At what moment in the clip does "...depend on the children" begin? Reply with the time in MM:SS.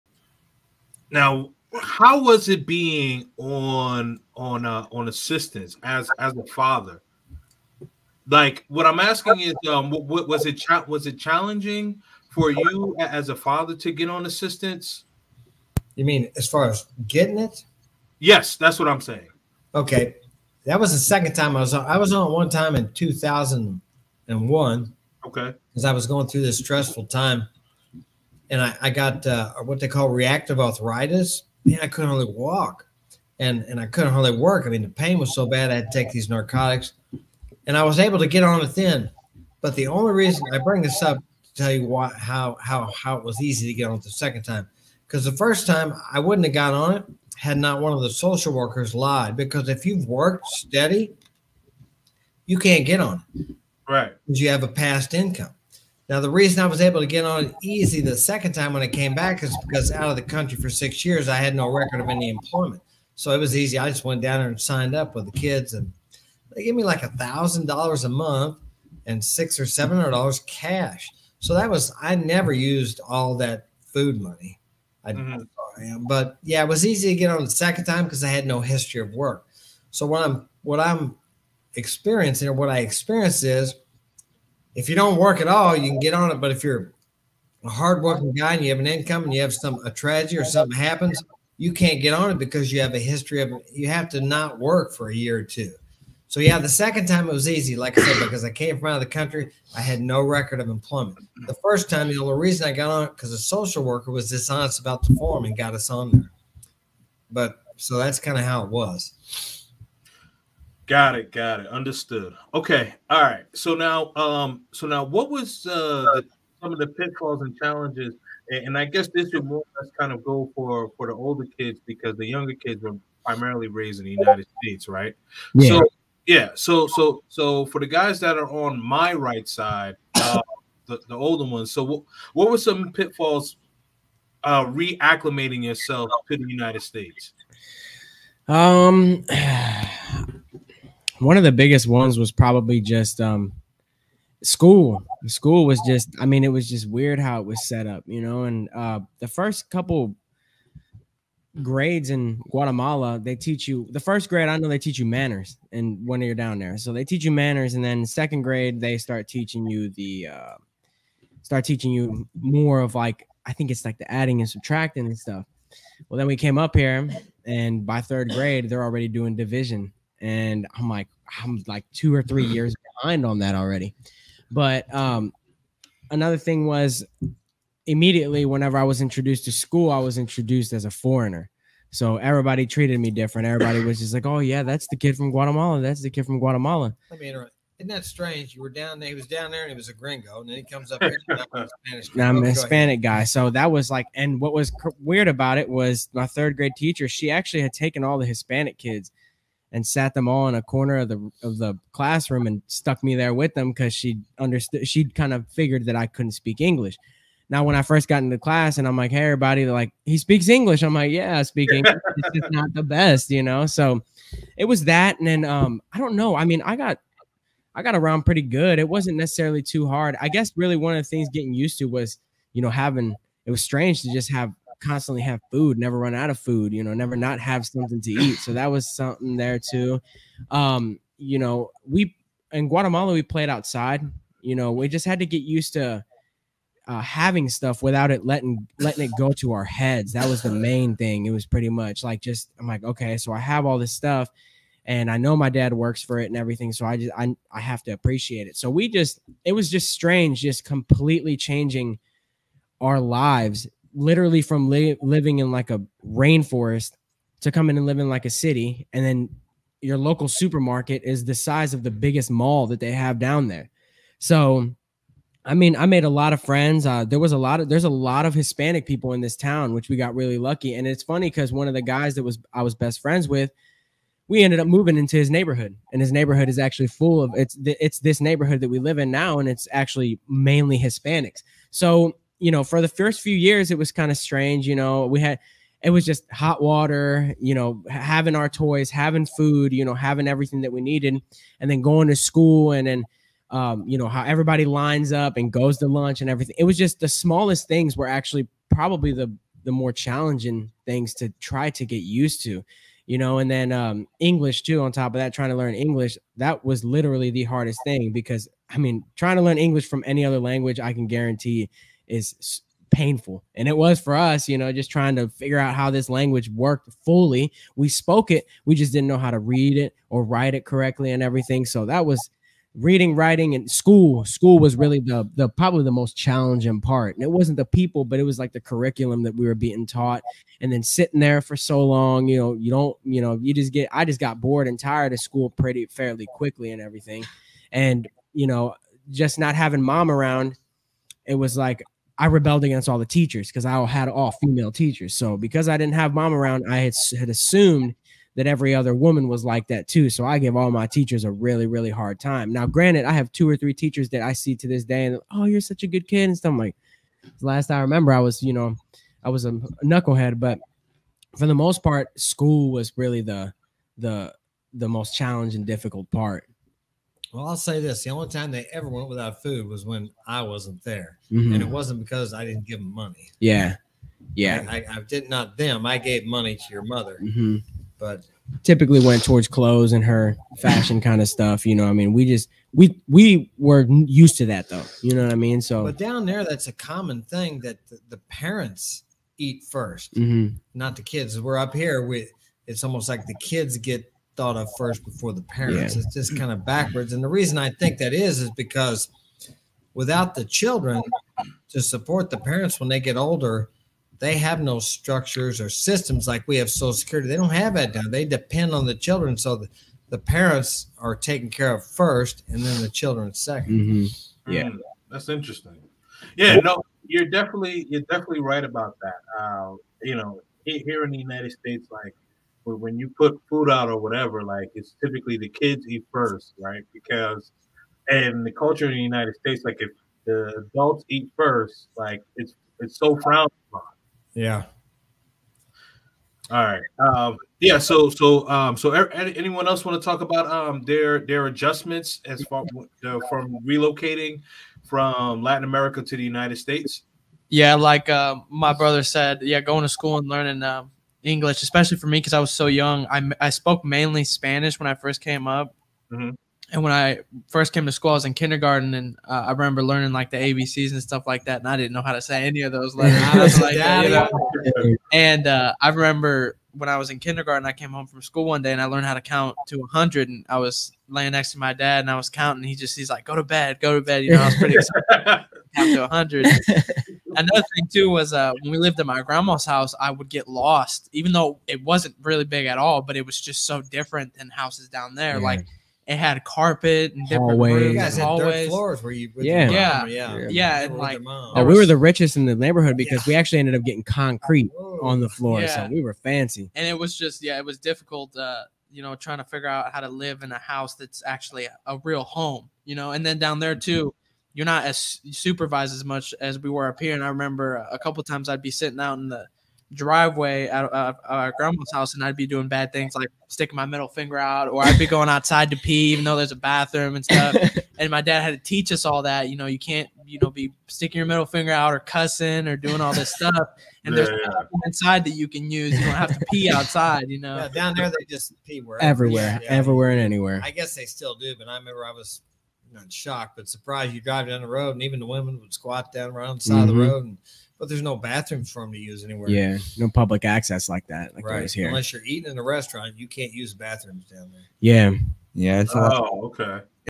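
06:48.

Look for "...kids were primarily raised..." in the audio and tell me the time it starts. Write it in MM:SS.
02:02.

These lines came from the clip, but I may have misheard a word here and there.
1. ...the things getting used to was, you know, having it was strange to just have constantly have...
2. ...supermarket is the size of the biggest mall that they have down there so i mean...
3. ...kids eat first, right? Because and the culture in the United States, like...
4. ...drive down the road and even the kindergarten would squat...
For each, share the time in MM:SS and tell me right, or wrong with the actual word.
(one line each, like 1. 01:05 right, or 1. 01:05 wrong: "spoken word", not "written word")
1. 03:41 right
2. 04:20 right
3. 07:05 right
4. 08:54 wrong: "women", not "kindergarten".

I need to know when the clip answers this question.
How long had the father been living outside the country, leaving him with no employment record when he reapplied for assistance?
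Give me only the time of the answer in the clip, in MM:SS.
01:00.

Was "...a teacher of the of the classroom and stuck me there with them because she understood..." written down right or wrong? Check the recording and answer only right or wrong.
wrong.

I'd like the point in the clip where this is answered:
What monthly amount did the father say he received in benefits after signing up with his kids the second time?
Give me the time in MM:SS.
01:07.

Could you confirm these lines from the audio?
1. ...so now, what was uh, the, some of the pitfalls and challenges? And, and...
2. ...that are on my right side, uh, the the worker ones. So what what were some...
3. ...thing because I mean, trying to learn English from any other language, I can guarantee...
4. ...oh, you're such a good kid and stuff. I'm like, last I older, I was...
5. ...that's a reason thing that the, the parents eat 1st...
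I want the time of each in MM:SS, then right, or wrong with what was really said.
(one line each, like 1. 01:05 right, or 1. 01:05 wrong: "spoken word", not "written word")
1. 01:54 right
2. 02:08 wrong: "older", not "worker"
3. 05:07 right
4. 05:55 wrong: "remember", not "older"
5. 06:26 wrong: "common", not "reason".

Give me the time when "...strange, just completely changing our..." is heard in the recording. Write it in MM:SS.
04:09.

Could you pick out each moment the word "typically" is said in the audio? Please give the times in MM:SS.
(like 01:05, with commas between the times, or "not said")
06:18, 07:05.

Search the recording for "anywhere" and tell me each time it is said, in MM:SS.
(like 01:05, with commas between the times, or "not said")
08:50, 08:59.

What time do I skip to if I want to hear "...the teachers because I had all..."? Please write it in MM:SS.
05:42.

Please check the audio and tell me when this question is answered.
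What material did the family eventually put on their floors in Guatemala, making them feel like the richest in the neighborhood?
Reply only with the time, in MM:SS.
08:14.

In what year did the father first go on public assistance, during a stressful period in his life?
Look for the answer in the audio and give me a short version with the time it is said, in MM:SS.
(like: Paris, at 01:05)
2001, at 00:22.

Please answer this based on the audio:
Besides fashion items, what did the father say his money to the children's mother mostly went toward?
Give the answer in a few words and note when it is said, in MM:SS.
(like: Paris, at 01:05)
Clothes, at 06:19.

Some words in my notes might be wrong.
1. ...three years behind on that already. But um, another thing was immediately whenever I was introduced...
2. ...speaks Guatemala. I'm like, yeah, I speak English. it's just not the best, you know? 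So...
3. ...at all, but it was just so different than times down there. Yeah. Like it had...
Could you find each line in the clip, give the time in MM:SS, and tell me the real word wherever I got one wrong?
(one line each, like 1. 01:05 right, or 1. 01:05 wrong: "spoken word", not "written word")
1. 02:52 right
2. 03:30 wrong: "English", not "Guatemala"
3. 08:02 wrong: "houses", not "times".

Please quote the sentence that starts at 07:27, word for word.
Yeah, like uh, my brother said, yeah, going to school and learning uh, English, especially for me because I was so young.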